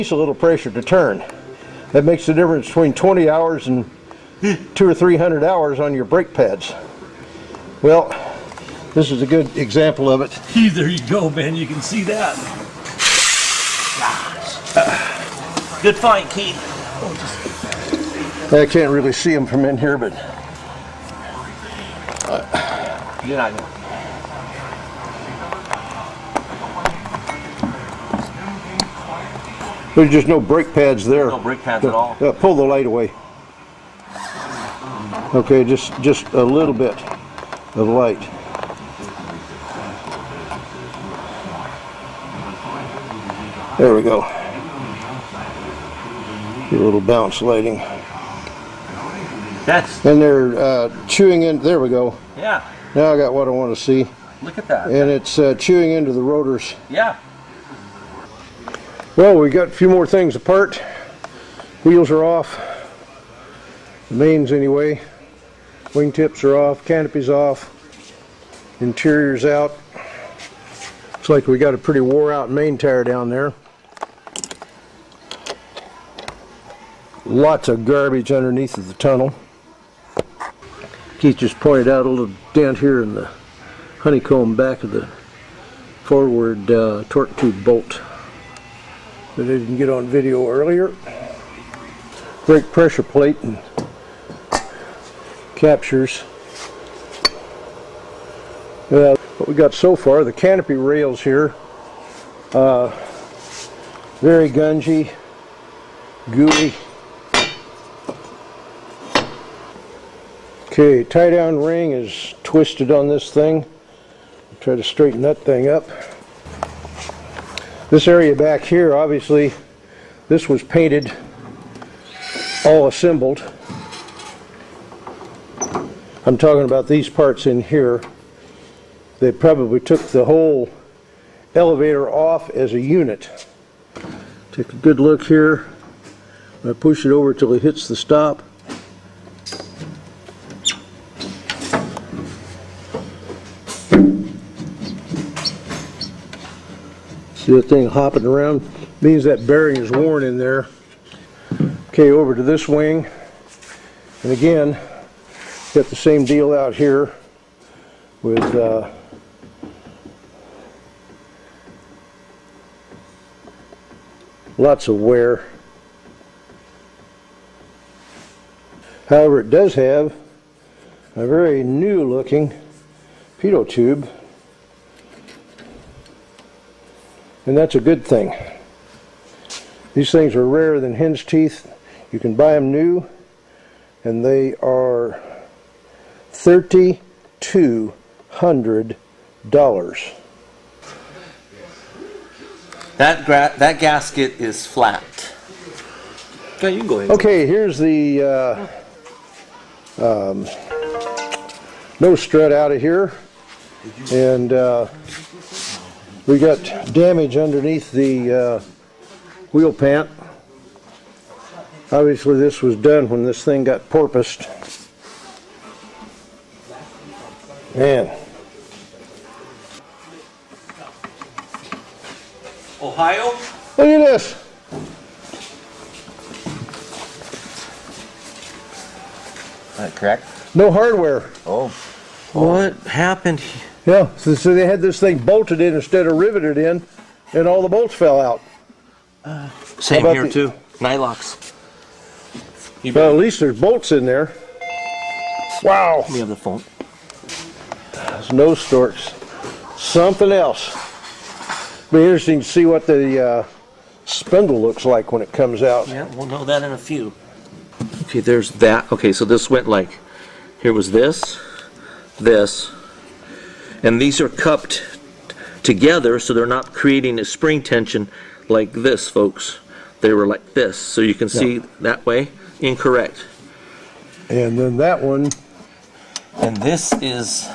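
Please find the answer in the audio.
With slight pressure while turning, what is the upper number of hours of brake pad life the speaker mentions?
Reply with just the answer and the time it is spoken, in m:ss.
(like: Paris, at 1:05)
300, at 0:04.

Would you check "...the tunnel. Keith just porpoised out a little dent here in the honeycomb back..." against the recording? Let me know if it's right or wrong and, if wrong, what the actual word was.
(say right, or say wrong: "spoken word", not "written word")
wrong: "pointed", not "porpoised".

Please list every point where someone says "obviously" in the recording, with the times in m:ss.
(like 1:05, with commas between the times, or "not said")
1:58, 3:31.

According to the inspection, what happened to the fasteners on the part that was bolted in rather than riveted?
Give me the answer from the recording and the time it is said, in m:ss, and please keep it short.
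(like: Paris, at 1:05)
All the bolts fell out, at 3:57.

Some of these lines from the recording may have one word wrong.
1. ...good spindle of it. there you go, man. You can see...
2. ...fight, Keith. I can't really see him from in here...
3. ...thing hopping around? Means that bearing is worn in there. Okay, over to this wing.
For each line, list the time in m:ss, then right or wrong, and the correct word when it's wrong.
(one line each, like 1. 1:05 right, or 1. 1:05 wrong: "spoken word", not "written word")
1. 0:09 wrong: "example", not "spindle"
2. 0:15 right
3. 2:27 right.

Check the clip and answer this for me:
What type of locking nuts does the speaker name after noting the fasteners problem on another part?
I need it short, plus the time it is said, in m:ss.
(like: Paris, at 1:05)
Nylocks, at 4:00.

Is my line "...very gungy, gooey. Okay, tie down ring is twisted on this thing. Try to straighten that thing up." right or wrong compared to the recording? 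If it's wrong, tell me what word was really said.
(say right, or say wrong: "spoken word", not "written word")
right.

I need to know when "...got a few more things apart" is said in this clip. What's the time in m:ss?
0:59.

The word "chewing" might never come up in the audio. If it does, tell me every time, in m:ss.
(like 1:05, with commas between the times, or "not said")
0:51, 0:55.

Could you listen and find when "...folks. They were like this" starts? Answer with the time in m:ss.
4:29.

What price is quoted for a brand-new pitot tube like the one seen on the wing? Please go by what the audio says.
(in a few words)
$3,200.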